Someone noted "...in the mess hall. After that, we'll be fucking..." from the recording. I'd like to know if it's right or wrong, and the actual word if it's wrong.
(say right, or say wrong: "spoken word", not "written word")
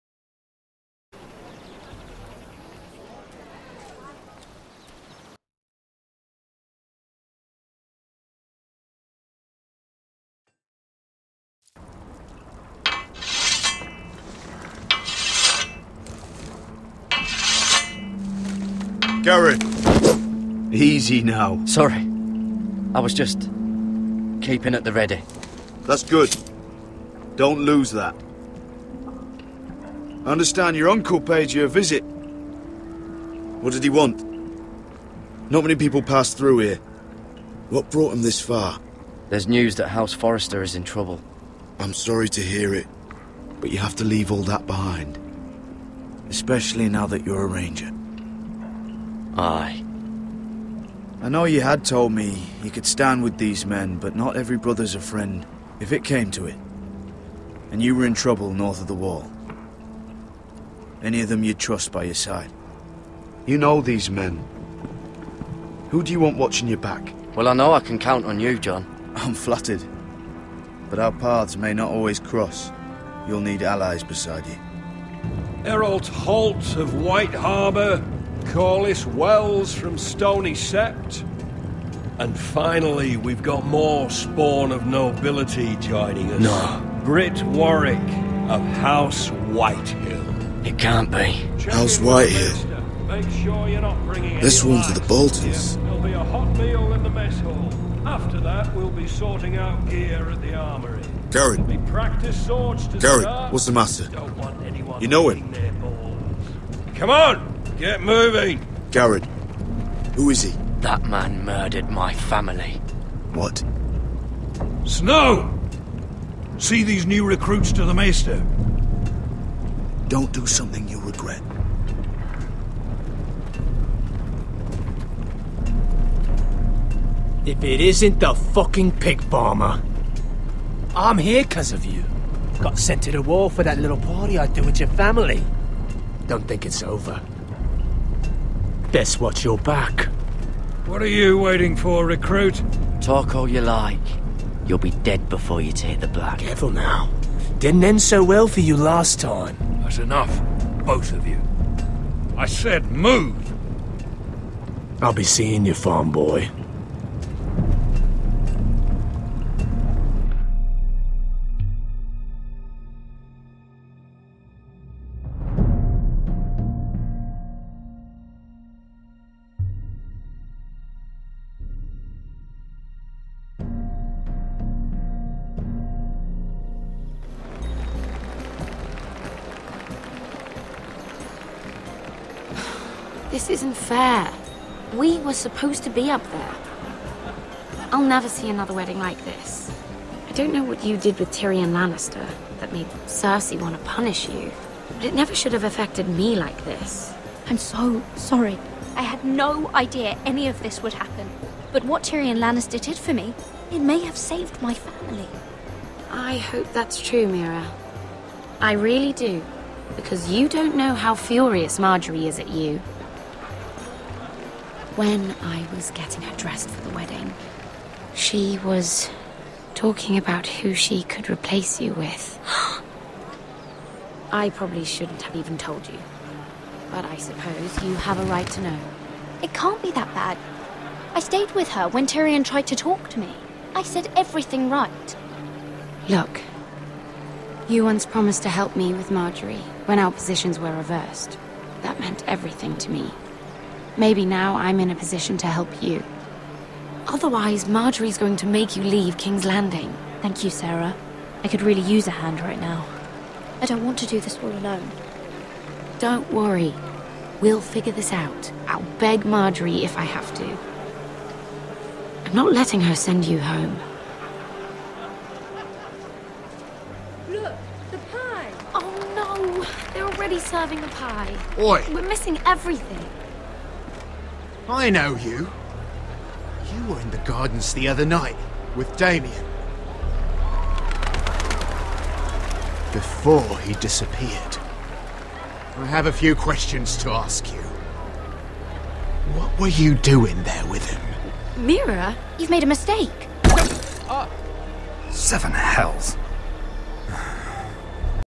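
wrong: "sorting", not "fucking".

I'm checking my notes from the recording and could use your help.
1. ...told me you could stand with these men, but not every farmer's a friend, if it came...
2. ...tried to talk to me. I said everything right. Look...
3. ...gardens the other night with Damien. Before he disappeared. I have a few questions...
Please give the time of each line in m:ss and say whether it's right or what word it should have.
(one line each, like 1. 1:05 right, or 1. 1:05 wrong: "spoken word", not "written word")
1. 0:51 wrong: "brother", not "farmer"
2. 3:52 right
3. 4:37 right.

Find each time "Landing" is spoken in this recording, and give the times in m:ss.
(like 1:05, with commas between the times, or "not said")
4:09.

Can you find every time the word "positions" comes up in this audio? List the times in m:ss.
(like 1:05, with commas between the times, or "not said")
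4:00, 4:04.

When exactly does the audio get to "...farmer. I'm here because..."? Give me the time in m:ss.
2:09.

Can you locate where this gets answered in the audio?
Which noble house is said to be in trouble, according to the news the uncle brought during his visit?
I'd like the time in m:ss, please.
0:39.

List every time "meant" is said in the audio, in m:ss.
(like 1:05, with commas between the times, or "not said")
4:02.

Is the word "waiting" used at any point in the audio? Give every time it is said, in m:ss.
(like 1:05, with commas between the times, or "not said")
2:21.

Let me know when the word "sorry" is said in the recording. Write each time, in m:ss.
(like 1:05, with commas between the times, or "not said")
0:21, 0:41, 3:18.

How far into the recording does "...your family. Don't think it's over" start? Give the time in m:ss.
2:14.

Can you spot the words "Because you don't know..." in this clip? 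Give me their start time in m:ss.
3:29.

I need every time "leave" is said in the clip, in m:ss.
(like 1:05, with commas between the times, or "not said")
0:44, 4:08.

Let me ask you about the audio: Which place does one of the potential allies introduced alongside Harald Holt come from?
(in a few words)
Stony Sept.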